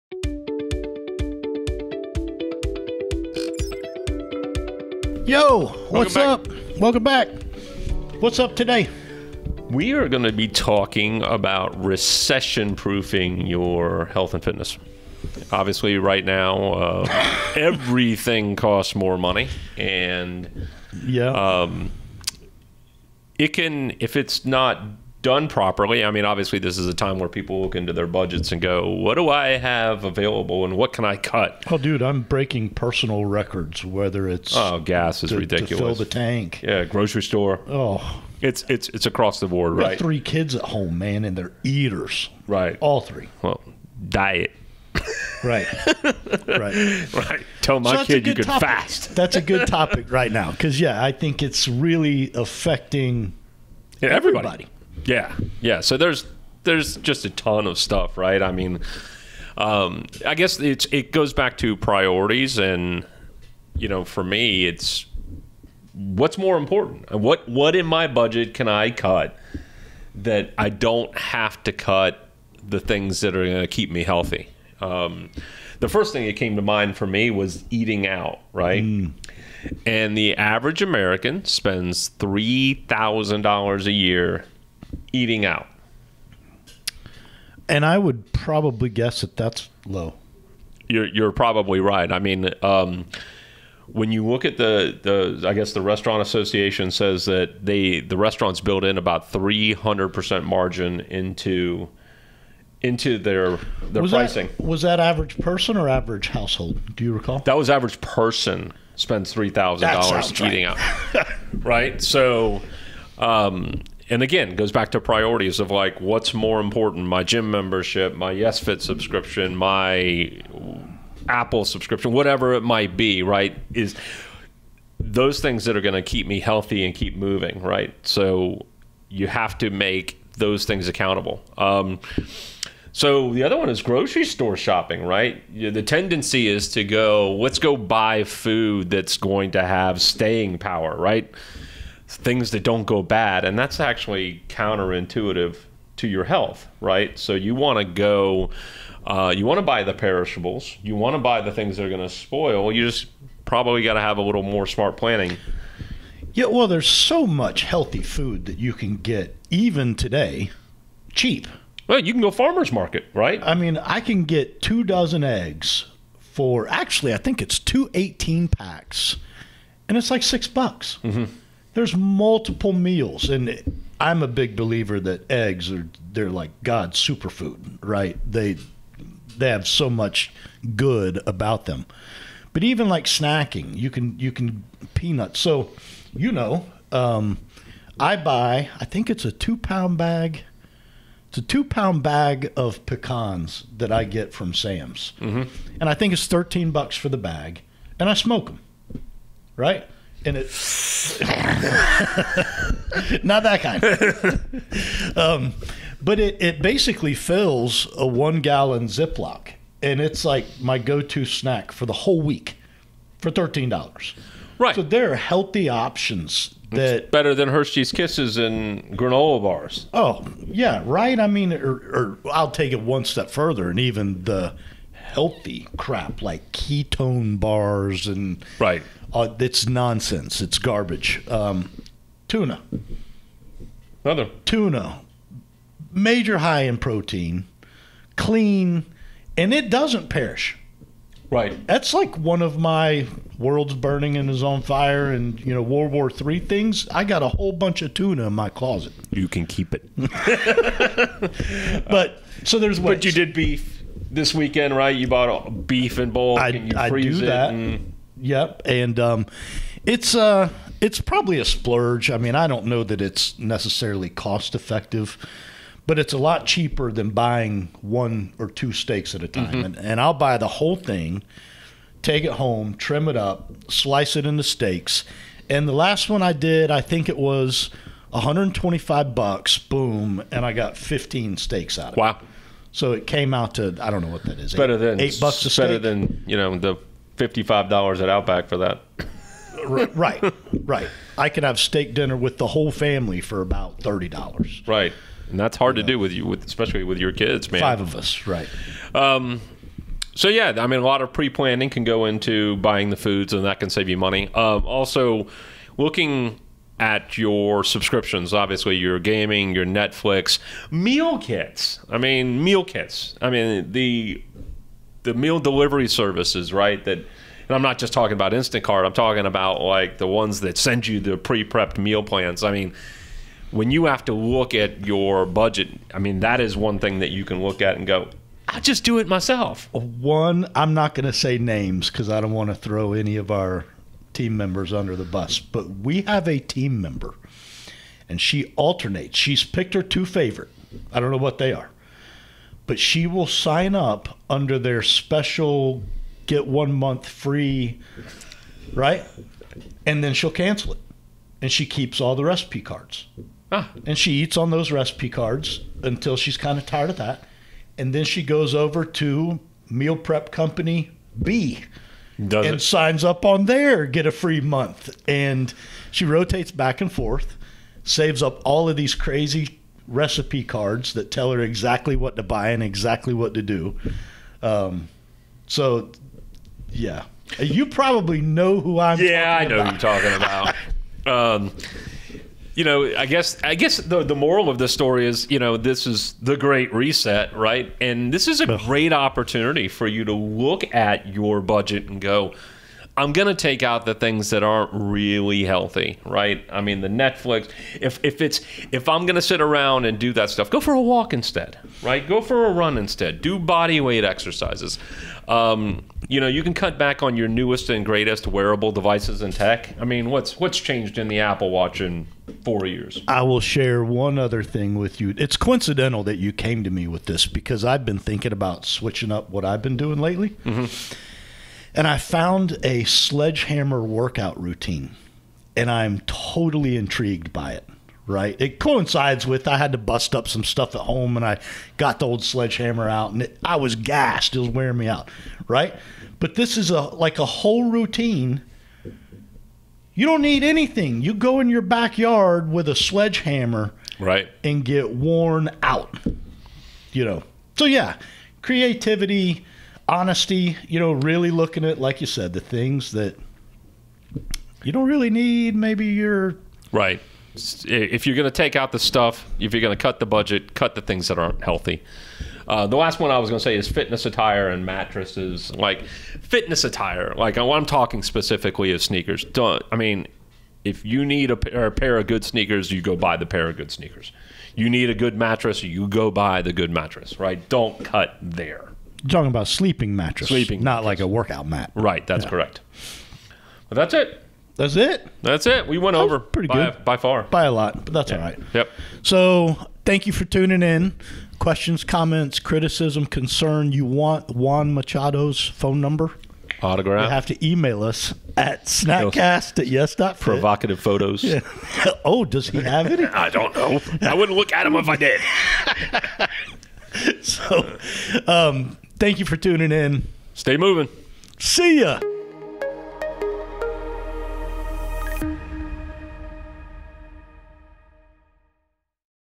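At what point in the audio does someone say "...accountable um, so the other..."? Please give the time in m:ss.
2:10.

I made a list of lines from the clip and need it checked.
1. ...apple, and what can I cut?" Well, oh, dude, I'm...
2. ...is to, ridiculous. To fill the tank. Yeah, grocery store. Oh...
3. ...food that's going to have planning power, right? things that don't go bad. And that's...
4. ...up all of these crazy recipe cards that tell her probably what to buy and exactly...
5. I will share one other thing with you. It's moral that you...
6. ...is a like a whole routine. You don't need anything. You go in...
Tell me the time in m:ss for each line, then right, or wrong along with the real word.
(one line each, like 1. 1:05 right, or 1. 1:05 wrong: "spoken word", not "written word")
1. 0:30 wrong: "available", not "apple"
2. 0:35 right
3. 2:18 wrong: "staying", not "planning"
4. 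6:08 wrong: "exactly", not "probably"
5. 6:53 wrong: "coincidental", not "moral"
6. 7:16 right.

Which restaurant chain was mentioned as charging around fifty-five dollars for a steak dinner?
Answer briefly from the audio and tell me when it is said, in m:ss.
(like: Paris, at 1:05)
Outback, at 4:48.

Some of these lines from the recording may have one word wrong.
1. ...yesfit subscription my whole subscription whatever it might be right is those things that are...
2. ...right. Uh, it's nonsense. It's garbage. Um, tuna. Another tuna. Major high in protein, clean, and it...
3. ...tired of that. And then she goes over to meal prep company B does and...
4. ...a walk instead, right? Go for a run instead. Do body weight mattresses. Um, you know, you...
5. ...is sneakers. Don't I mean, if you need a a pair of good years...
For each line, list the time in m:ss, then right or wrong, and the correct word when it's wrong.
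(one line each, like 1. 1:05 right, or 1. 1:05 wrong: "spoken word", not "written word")
1. 1:58 wrong: "apple", not "whole"
2. 3:48 right
3. 5:56 right
4. 6:40 wrong: "exercises", not "mattresses"
5. 7:48 wrong: "sneakers", not "years".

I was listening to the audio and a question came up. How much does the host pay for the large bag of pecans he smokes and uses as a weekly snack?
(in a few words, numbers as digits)
$13.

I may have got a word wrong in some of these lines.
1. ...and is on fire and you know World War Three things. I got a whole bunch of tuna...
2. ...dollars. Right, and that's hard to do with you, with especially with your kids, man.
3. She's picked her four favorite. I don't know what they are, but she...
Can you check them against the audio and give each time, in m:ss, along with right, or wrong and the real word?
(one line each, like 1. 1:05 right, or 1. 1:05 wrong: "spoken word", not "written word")
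1. 4:04 right
2. 4:54 right
3. 5:39 wrong: "two", not "four".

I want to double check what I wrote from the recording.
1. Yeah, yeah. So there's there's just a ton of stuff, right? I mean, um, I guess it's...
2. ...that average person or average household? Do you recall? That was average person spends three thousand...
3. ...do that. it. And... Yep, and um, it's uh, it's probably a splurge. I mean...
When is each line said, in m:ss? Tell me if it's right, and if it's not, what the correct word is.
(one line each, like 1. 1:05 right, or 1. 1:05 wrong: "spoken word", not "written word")
1. 0:55 right
2. 1:44 right
3. 4:17 right.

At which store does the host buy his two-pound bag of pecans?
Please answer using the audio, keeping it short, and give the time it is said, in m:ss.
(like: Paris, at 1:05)
Sam's, at 3:14.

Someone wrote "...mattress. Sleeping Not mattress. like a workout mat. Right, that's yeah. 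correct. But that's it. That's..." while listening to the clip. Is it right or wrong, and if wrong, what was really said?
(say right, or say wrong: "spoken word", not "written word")
right.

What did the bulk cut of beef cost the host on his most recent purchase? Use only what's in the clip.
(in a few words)
$125.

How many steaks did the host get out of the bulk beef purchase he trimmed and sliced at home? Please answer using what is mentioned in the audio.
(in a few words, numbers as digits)
15.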